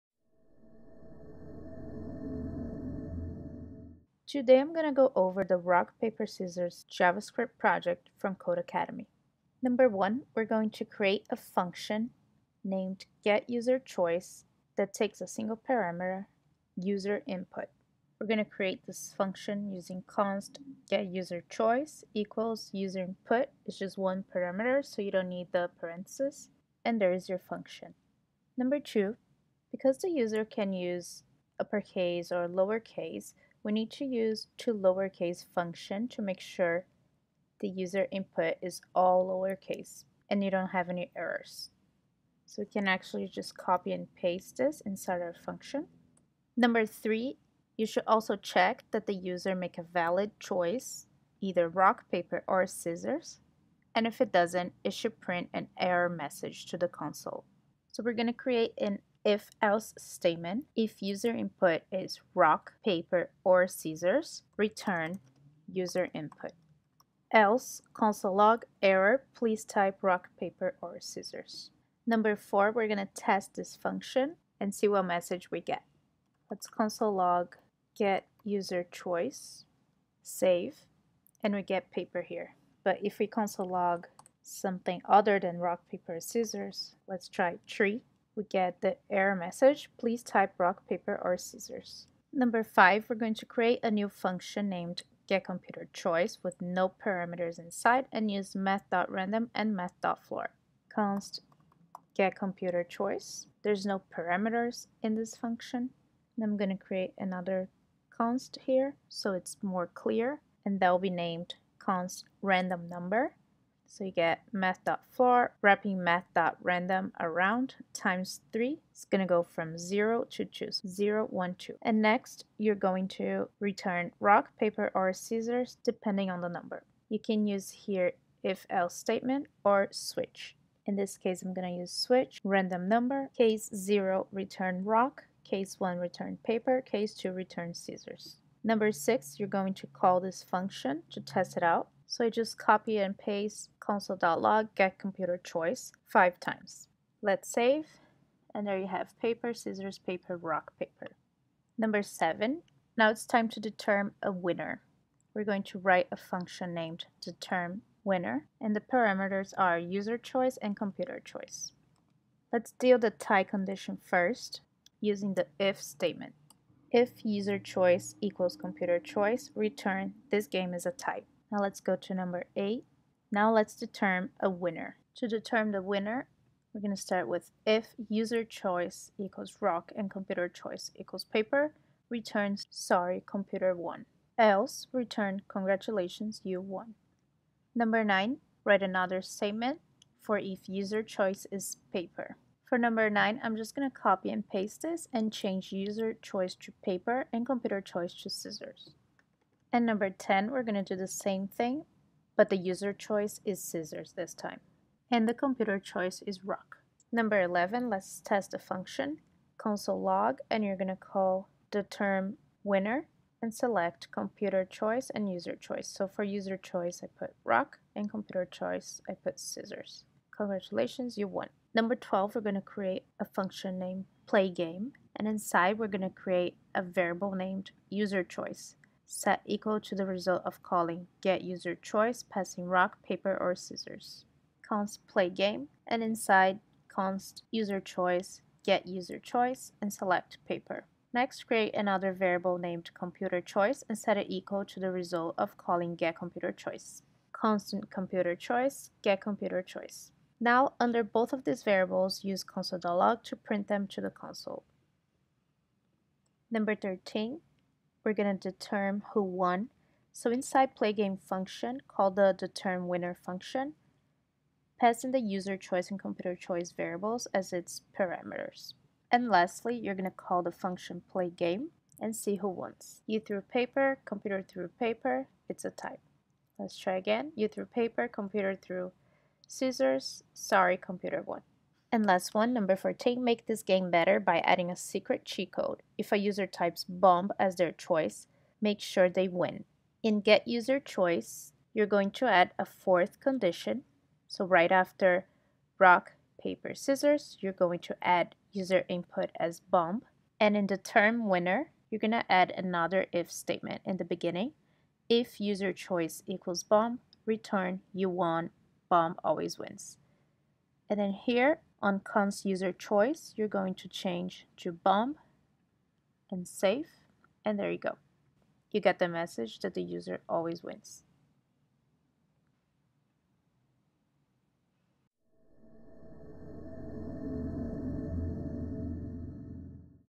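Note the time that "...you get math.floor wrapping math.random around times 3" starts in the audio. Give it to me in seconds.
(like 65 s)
114 s.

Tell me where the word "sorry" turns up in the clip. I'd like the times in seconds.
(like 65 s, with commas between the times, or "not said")
182 s, 280 s.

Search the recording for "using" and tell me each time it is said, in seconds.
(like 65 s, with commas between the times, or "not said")
19 s, 164 s.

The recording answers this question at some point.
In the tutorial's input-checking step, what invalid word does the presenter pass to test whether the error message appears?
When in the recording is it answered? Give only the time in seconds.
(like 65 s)
87 s.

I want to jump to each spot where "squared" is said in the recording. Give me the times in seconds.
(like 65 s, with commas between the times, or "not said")
not said.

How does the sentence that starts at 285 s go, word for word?
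If a user types bomb as their choice, make sure they win.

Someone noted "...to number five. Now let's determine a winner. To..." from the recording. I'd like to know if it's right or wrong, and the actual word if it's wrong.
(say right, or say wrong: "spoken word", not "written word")
wrong: "eight", not "five".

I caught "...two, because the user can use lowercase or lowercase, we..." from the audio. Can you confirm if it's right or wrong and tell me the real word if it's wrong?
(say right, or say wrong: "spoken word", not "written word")
wrong: "uppercase", not "lowercase".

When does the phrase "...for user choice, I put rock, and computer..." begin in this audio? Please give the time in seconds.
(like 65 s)
216 s.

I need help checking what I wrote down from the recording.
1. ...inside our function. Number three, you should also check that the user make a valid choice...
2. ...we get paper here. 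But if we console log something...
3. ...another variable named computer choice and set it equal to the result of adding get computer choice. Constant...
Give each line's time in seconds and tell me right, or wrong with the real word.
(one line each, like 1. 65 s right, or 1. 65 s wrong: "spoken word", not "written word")
1. 44 s right
2. 81 s right
3. 241 s wrong: "calling", not "adding".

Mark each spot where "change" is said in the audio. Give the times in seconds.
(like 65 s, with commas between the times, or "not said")
195 s, 313 s.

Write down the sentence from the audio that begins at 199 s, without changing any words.
And number 10, we're going to do the same thing, but the user choice is scissors this time.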